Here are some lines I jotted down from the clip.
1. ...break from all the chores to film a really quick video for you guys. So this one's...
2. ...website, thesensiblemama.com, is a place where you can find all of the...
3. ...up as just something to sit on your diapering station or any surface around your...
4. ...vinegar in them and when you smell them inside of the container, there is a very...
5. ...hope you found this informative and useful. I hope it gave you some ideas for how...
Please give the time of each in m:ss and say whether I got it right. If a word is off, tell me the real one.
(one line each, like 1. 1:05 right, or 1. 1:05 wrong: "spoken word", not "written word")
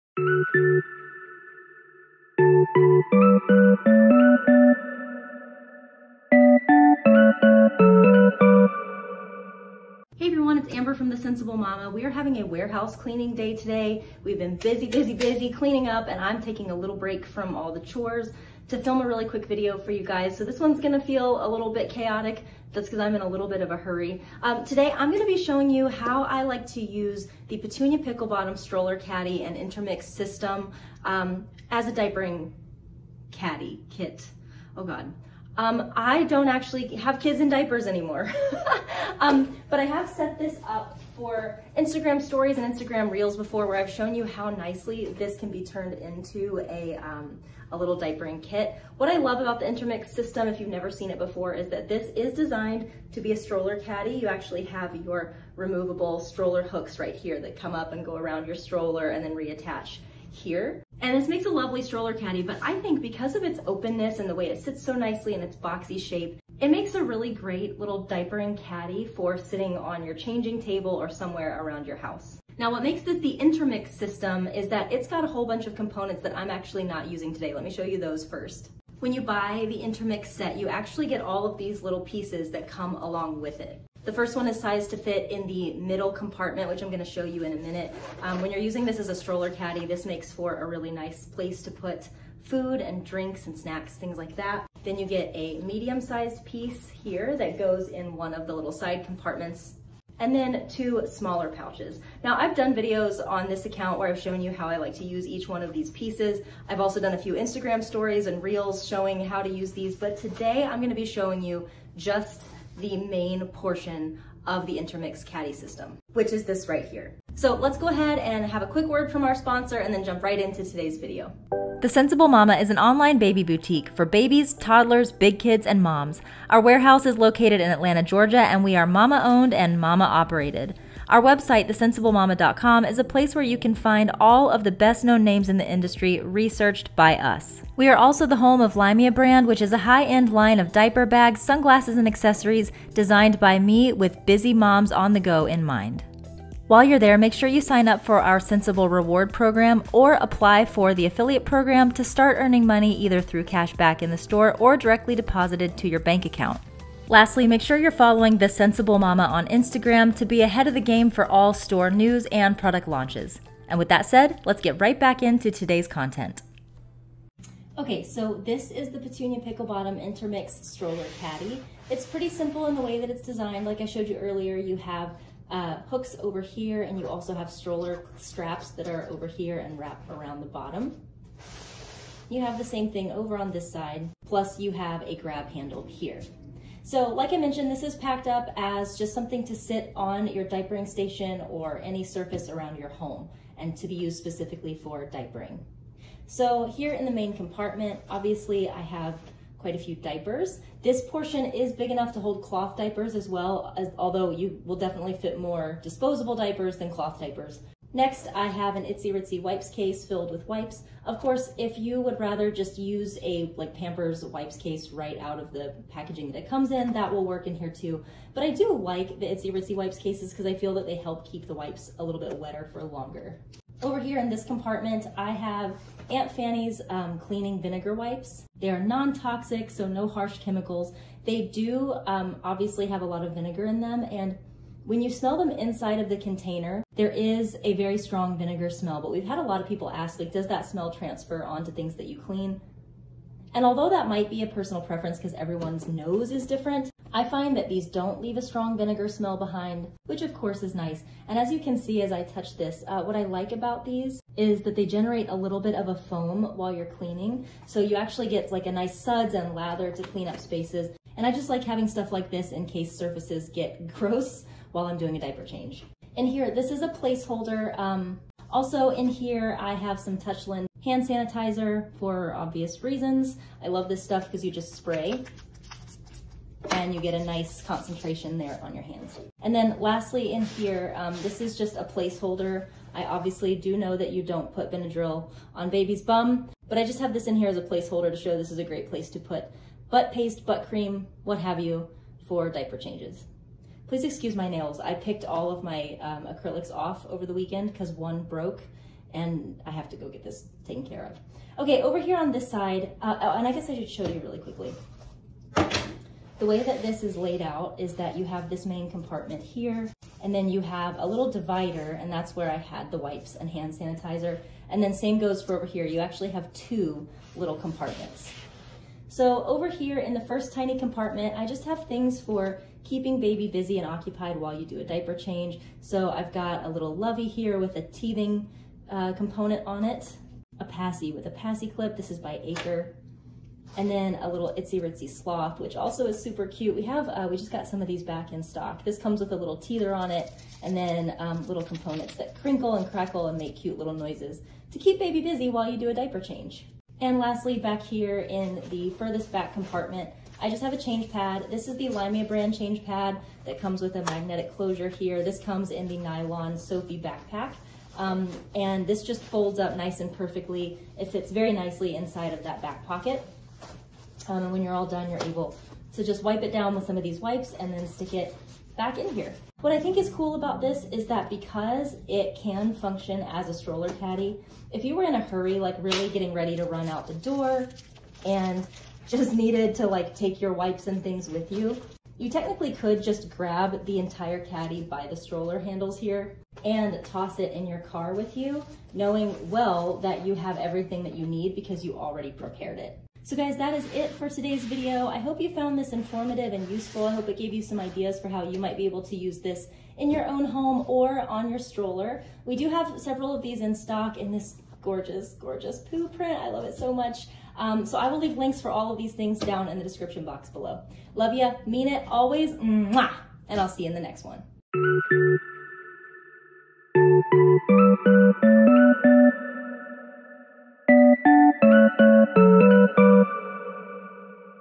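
1. 0:16 right
2. 2:11 right
3. 3:08 right
4. 3:53 right
5. 6:35 right.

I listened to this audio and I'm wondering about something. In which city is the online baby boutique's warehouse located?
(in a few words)
Atlanta, Georgia.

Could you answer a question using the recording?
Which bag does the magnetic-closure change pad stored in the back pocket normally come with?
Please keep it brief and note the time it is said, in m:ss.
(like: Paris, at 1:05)
nylon Sophie backpack, at 5:55.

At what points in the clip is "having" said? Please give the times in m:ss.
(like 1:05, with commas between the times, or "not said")
0:12, 4:21.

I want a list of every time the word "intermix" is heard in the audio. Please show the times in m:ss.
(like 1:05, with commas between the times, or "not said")
0:29, 0:49, 1:13, 1:19, 1:54, 2:49.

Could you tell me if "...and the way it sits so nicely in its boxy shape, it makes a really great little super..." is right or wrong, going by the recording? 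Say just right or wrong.
wrong.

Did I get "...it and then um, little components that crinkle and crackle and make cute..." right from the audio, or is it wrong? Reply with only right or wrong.
right.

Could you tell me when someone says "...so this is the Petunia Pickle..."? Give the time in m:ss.
2:48.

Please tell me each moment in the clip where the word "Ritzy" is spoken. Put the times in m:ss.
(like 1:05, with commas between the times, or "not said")
3:29, 3:39, 5:34.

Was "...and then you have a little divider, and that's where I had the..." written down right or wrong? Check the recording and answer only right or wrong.
right.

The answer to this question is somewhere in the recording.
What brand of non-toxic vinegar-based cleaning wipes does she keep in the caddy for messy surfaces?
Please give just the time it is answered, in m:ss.
3:46.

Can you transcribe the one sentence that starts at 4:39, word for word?
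And then lastly in here, um, this is just a placeholder.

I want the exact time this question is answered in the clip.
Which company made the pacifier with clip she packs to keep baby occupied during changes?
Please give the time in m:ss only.
5:32.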